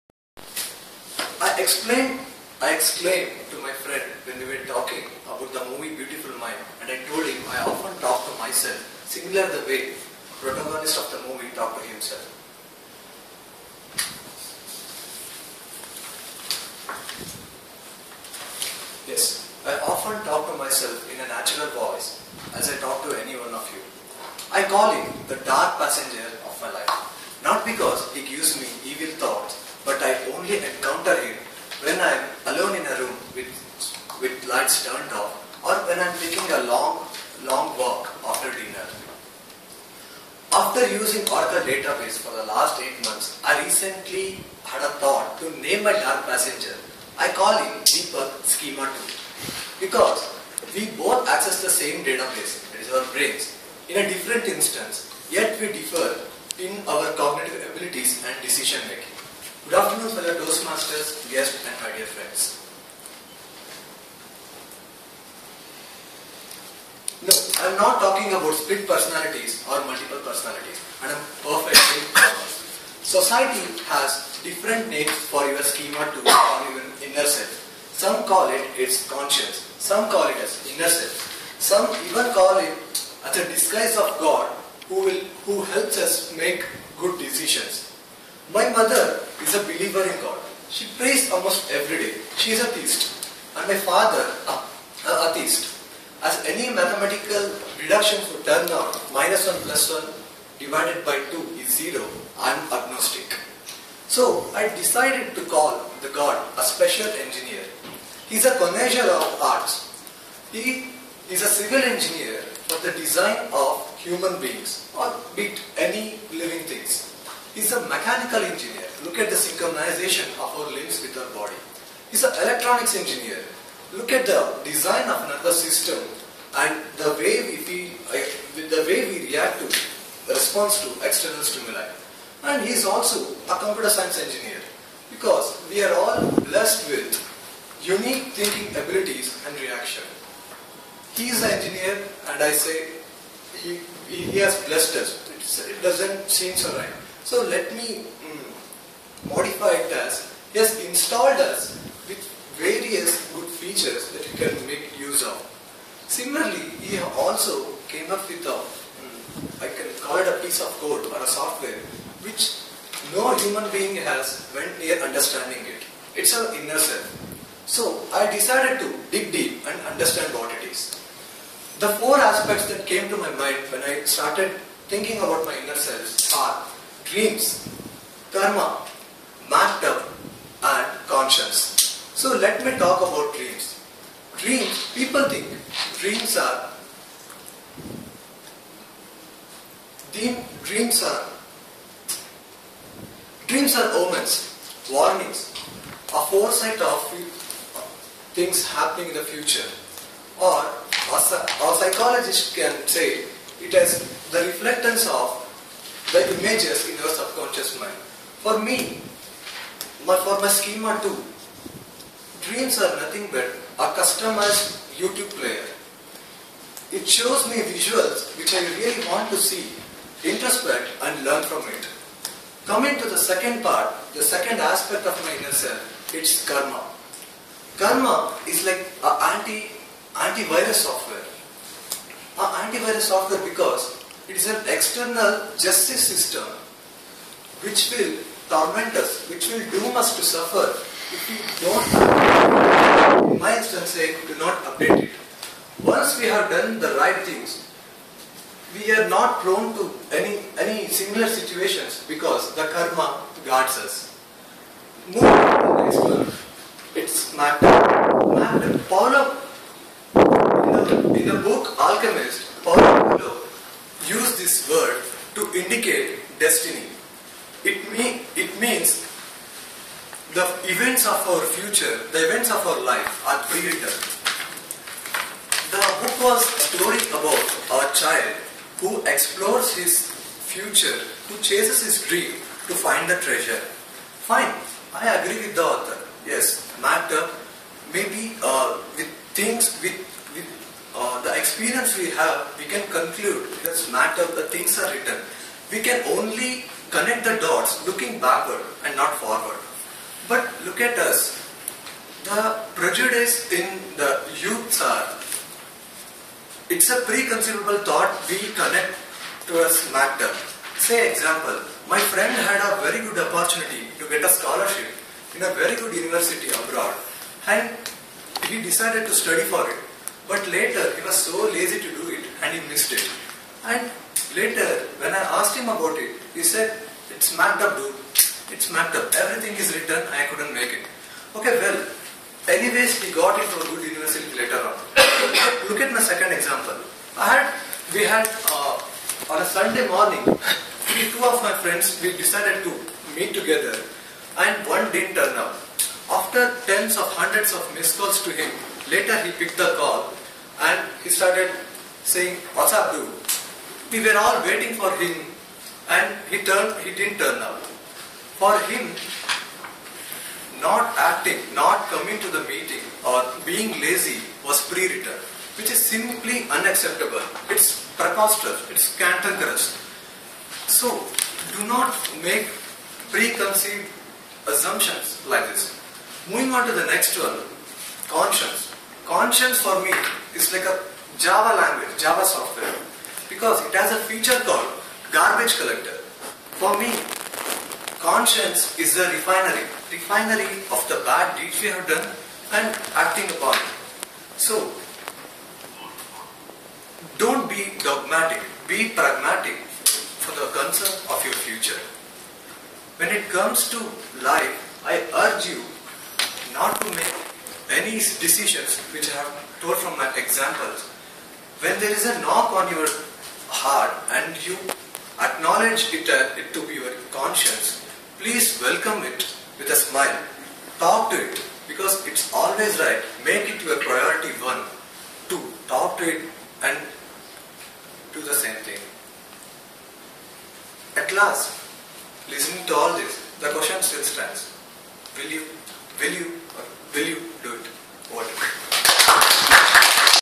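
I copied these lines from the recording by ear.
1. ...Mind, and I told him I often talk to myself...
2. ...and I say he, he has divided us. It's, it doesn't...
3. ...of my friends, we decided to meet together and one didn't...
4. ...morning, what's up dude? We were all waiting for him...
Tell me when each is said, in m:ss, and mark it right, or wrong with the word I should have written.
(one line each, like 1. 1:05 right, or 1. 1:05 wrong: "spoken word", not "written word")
1. 0:06 right
2. 2:22 wrong: "blessed", not "divided"
3. 5:41 right
4. 5:52 wrong: "saying", not "morning".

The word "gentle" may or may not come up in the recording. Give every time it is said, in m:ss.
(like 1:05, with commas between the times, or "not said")
not said.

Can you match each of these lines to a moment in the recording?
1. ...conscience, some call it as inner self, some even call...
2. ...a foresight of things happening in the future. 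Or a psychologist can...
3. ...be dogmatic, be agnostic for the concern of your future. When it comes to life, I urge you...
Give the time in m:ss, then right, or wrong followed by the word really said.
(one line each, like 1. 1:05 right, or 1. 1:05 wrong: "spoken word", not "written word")
1. 1:19 right
2. 3:16 right
3. 6:37 wrong: "pragmatic", not "agnostic".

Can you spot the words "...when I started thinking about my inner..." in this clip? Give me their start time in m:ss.
2:53.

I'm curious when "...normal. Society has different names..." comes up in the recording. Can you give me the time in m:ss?
1:12.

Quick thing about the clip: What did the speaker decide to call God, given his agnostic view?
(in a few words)
special engineer.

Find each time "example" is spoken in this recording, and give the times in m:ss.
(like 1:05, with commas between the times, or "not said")
5:11, 5:36, 6:50.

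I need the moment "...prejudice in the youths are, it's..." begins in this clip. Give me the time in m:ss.
5:02.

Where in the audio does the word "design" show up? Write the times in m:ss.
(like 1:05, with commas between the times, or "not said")
1:52, 2:04.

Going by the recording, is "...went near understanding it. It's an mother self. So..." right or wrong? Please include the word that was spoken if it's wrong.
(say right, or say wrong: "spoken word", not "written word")
wrong: "inner", not "mother".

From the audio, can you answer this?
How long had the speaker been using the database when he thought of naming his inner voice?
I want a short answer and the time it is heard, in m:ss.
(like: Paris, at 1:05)
8 months, at 0:42.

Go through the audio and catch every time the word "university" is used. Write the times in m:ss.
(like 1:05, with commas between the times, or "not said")
5:15, 5:33.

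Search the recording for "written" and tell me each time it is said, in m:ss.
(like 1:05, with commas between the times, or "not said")
4:33, 4:54, 5:29, 6:04.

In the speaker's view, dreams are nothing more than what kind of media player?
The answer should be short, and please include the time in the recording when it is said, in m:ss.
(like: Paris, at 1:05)
customized YouTube player, at 3:33.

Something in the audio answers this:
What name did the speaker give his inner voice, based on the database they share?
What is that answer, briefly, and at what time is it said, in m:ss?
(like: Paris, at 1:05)
Deepak Schema 2, at 0:47.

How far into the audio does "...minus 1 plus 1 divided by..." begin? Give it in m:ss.
1:39.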